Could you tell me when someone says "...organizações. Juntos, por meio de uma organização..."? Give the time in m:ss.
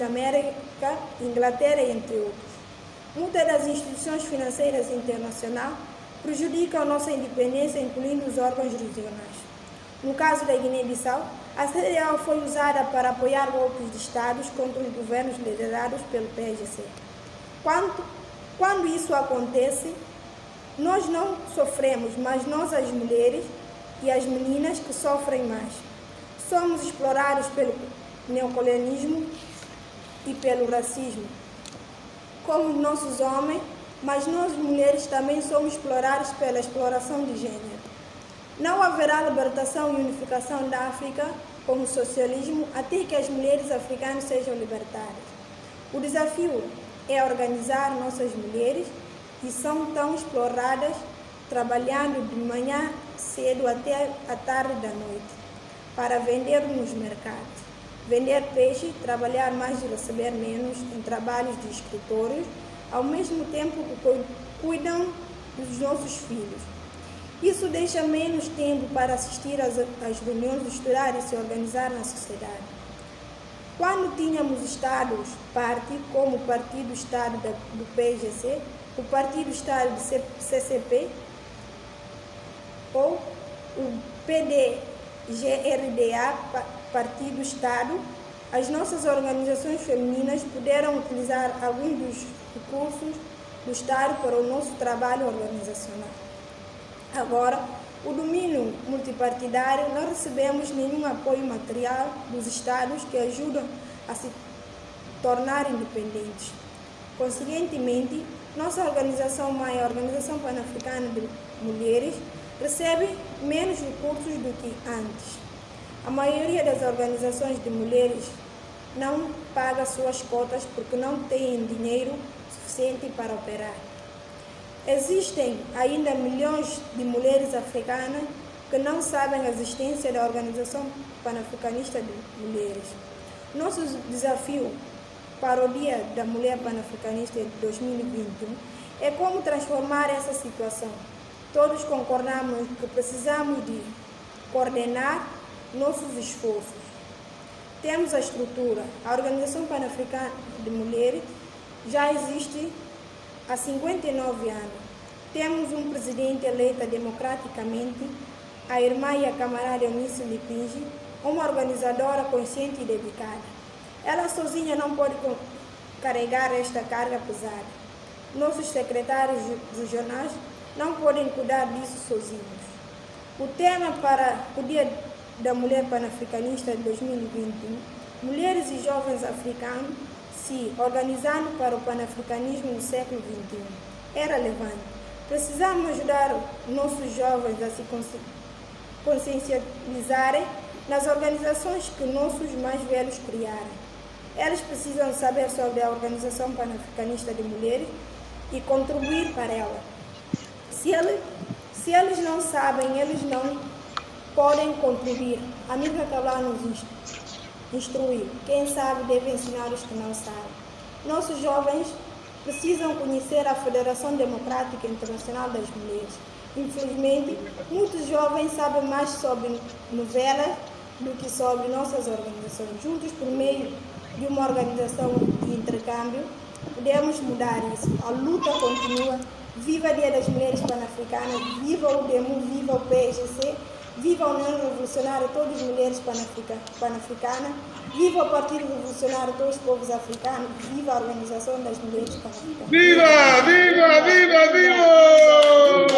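3:42.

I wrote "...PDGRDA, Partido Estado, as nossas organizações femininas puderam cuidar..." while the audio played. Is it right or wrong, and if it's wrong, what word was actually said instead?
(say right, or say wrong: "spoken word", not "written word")
wrong: "utilizar", not "cuidar".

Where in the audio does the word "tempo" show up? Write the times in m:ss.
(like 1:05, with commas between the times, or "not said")
1:03, 1:08.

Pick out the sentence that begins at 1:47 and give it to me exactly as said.
Consequentemente, nossa organização mãe, a Organização Pan-Africana de Mulheres, recebe menos recursos do que antes.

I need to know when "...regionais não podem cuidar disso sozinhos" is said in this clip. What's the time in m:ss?
2:49.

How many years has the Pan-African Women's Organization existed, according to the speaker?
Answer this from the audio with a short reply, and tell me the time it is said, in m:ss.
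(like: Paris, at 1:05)
59, at 2:33.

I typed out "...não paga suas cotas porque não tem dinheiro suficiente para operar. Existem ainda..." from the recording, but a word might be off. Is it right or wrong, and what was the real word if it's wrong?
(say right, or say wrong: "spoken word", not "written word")
right.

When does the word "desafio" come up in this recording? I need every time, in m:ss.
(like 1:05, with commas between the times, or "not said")
0:45, 2:14.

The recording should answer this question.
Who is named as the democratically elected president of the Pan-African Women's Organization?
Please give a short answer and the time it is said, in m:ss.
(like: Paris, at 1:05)
Eunice Lipinge, at 2:39.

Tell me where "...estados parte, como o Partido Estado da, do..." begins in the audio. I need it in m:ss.
1:14.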